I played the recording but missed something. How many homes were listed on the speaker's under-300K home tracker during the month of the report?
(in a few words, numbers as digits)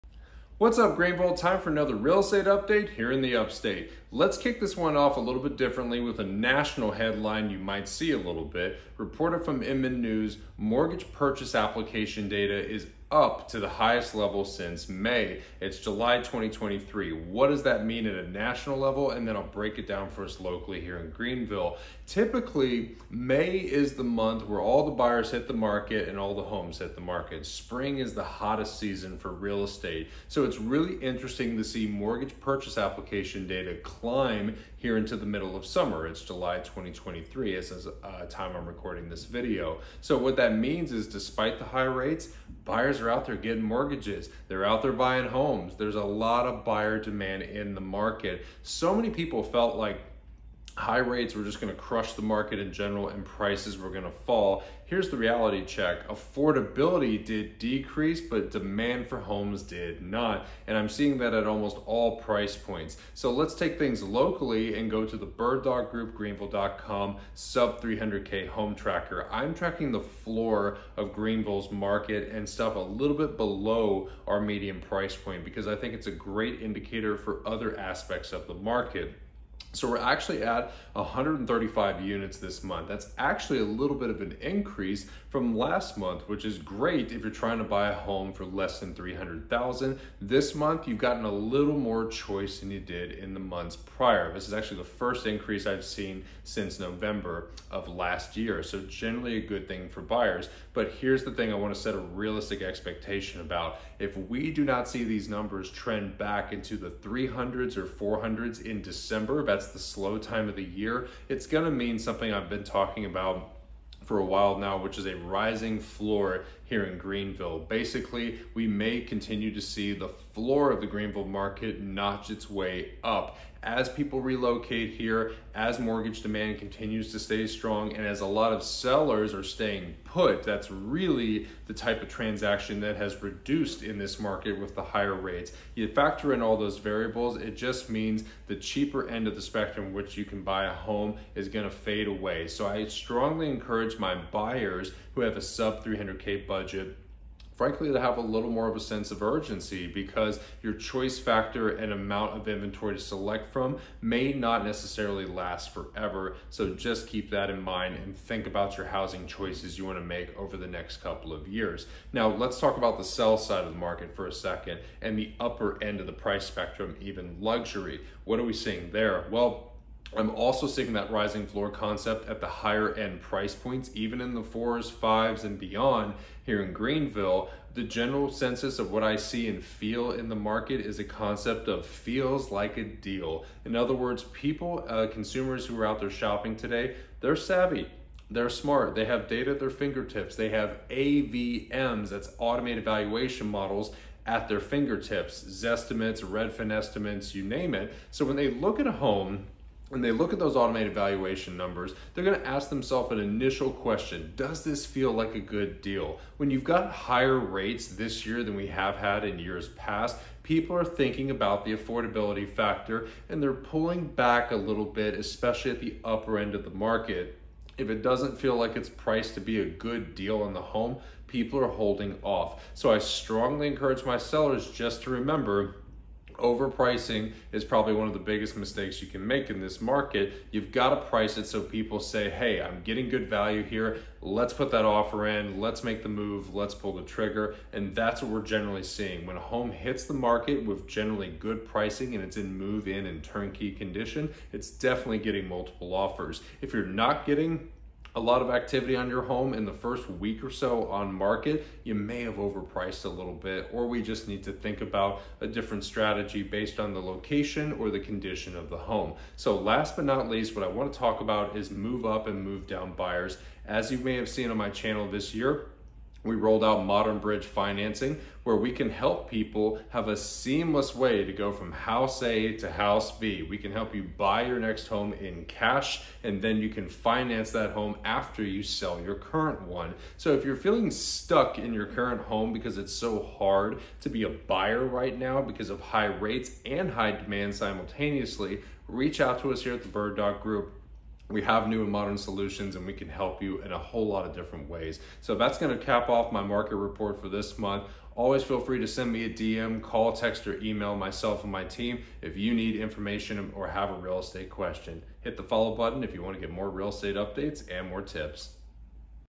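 135.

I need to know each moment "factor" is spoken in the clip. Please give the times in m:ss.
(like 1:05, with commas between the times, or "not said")
2:15, 2:31, 3:32.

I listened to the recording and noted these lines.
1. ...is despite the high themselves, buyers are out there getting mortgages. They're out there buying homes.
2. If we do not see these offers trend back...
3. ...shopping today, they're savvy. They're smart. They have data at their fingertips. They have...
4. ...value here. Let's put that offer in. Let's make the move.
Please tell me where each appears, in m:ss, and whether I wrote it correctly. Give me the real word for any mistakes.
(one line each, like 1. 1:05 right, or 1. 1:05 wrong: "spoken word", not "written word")
1. 0:40 wrong: "rates", not "themselves"
2. 1:43 wrong: "numbers", not "offers"
3. 3:06 right
4. 3:53 right.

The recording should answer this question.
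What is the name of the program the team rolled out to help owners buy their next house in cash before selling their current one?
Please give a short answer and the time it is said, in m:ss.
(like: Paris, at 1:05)
Modern Bridge Financing, at 4:26.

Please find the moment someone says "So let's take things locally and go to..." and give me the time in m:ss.
1:03.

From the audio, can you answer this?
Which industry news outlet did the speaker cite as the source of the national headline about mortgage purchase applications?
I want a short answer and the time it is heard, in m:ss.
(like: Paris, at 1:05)
Inman News, at 0:09.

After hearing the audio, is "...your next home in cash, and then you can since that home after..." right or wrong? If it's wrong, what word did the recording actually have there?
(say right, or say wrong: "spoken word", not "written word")
wrong: "finance", not "since".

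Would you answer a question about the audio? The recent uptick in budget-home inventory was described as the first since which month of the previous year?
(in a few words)
November.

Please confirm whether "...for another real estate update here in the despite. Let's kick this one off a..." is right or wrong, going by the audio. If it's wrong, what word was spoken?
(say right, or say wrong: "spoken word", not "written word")
wrong: "upstate", not "despite".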